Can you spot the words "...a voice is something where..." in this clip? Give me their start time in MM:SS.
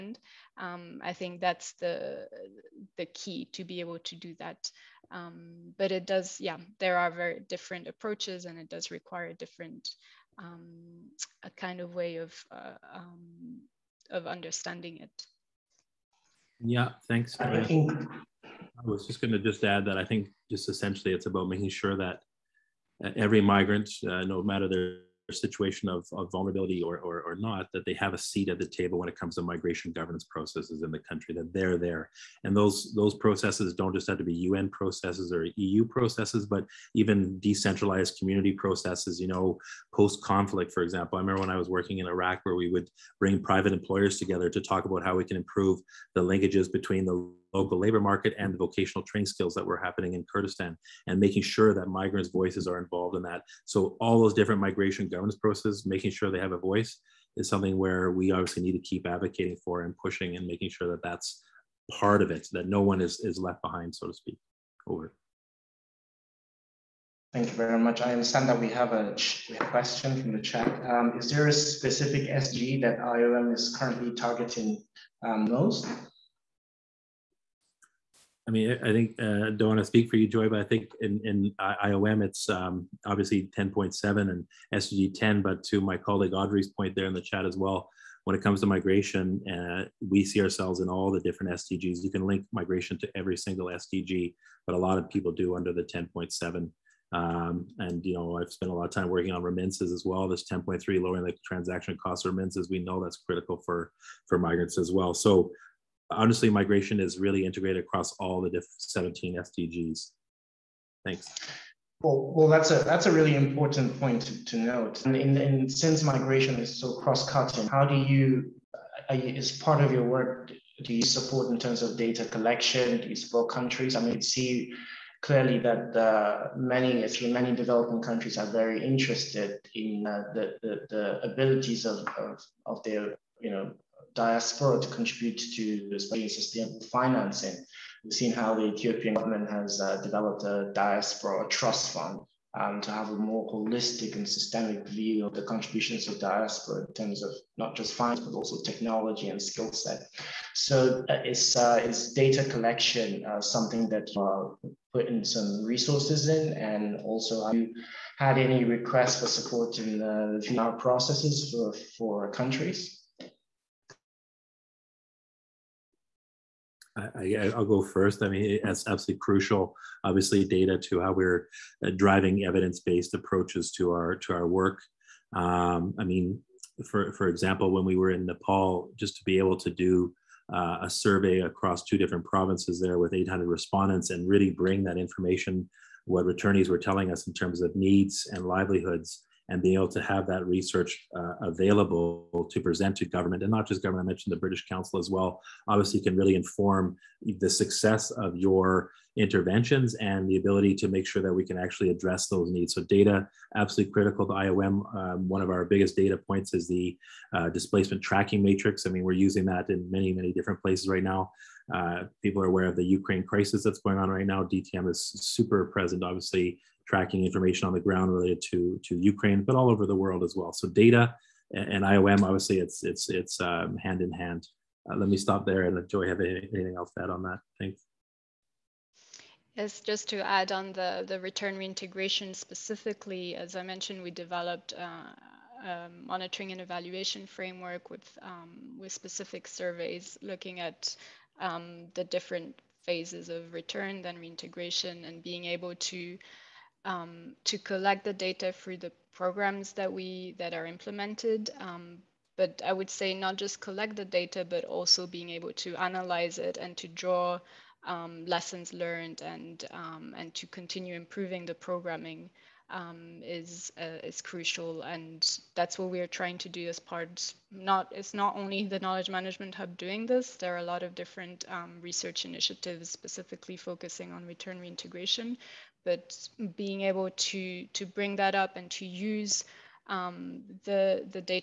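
00:56.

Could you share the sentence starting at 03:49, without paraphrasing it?
Yes, just to add on the the return reintegration specifically, as I mentioned, we developed.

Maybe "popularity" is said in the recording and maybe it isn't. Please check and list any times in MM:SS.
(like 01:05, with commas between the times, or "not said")
not said.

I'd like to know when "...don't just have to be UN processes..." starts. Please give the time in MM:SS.
00:33.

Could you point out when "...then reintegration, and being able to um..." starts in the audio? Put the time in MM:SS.
04:04.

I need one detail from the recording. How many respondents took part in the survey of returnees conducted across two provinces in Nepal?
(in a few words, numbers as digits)
800.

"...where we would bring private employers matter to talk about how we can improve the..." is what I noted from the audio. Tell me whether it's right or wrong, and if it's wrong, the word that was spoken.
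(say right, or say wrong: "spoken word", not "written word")
wrong: "together", not "matter".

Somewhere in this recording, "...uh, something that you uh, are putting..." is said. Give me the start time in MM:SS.
02:33.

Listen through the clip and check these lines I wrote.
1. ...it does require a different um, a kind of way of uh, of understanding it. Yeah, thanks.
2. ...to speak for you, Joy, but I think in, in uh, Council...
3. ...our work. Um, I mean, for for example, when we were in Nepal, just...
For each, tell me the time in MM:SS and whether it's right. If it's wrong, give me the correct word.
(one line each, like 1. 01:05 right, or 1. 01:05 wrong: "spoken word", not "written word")
1. 00:08 right
2. 01:19 wrong: "IOM", not "Council"
3. 02:54 right.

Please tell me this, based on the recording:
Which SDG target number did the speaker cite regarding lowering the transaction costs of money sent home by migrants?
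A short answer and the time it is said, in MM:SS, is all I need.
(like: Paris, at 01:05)
10.3, at 01:40.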